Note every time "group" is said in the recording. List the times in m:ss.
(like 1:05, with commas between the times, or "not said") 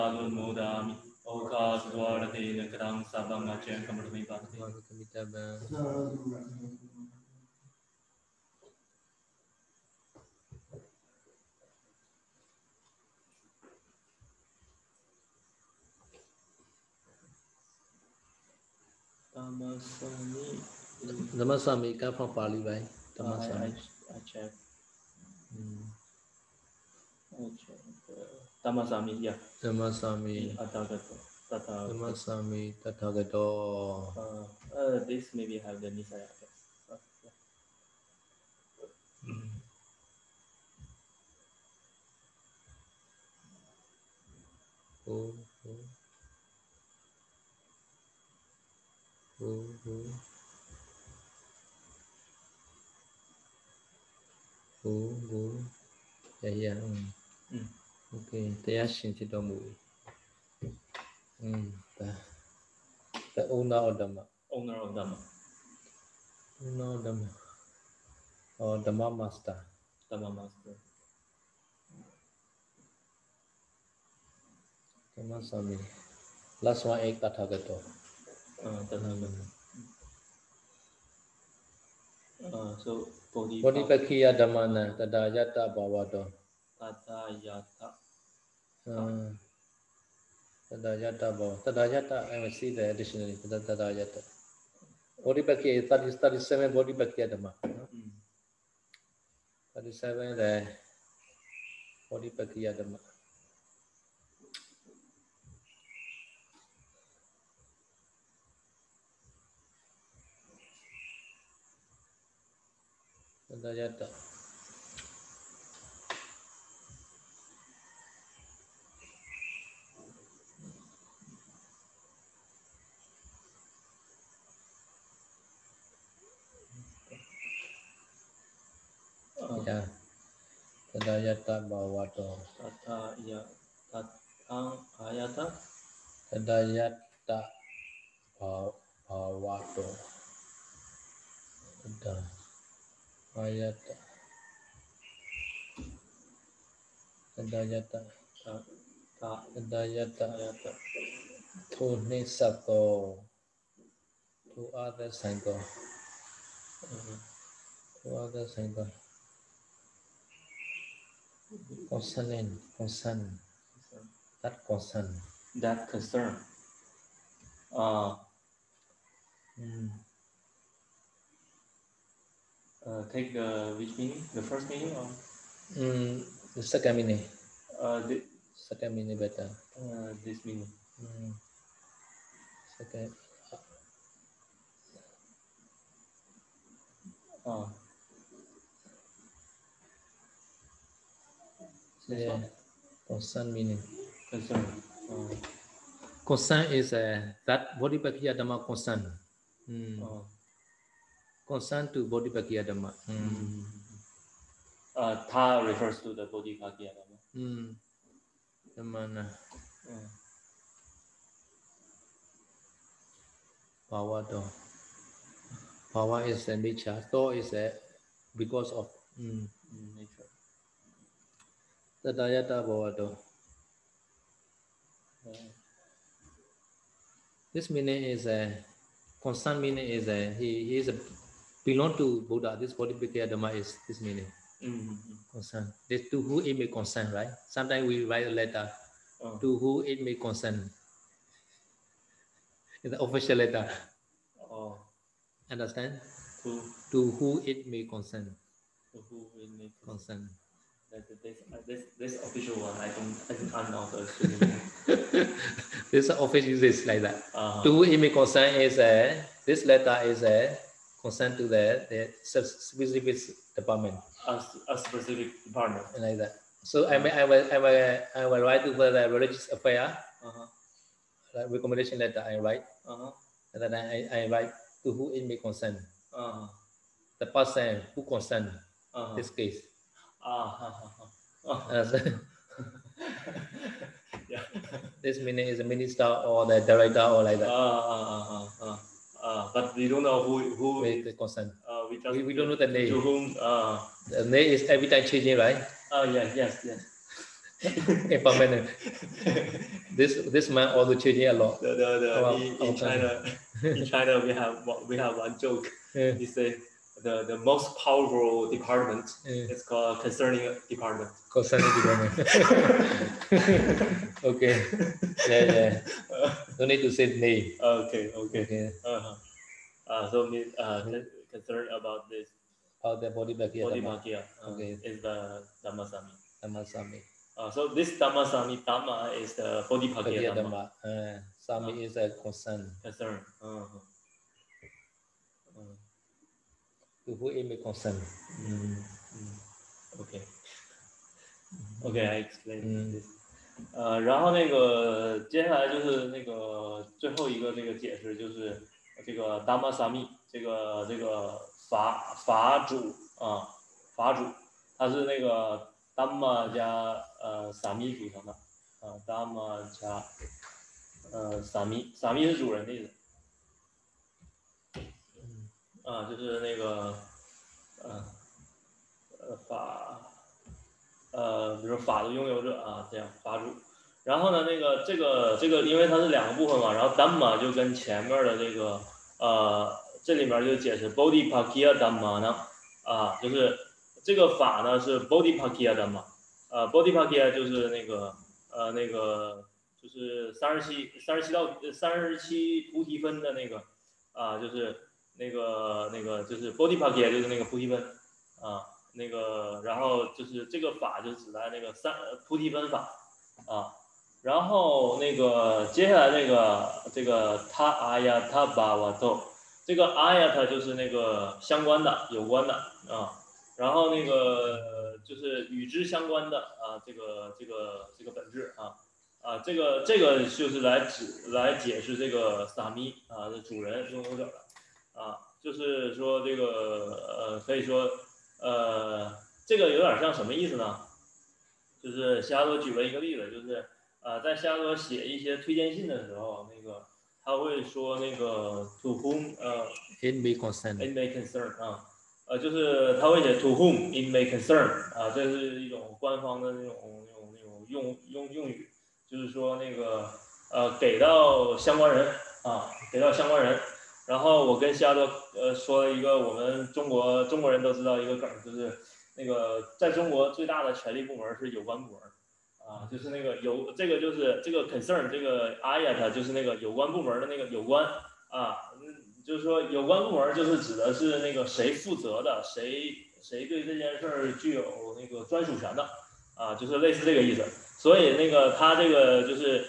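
not said.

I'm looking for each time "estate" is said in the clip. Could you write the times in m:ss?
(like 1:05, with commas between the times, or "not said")
not said.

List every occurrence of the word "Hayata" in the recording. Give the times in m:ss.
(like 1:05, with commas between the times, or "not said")
2:23.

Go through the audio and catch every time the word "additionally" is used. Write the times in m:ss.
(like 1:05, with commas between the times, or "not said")
1:32.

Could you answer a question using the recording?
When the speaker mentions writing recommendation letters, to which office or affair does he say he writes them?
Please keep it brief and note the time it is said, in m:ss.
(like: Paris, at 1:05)
Religious affair, at 4:29.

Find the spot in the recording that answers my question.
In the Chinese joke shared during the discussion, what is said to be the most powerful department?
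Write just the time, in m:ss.
5:09.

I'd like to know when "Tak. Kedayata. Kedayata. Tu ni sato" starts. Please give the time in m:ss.
2:29.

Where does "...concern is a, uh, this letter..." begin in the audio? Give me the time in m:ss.
4:18.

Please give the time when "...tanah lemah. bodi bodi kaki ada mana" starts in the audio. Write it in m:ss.
1:18.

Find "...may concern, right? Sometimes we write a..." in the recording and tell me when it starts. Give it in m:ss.
3:56.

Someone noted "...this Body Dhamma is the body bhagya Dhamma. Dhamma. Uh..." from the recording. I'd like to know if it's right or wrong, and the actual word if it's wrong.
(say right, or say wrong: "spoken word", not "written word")
wrong: "Dhammasami", not "Body".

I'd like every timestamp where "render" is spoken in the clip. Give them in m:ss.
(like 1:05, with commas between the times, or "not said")
not said.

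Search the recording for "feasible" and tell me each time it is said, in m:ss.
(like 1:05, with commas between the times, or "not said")
not said.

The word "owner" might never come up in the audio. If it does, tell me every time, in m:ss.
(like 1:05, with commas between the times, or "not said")
1:04.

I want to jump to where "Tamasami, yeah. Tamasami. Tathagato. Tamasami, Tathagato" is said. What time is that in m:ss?
0:28.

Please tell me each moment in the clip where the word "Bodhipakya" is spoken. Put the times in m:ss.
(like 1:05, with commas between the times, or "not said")
3:17, 3:22, 3:26, 3:52.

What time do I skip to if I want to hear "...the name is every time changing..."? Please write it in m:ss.
4:54.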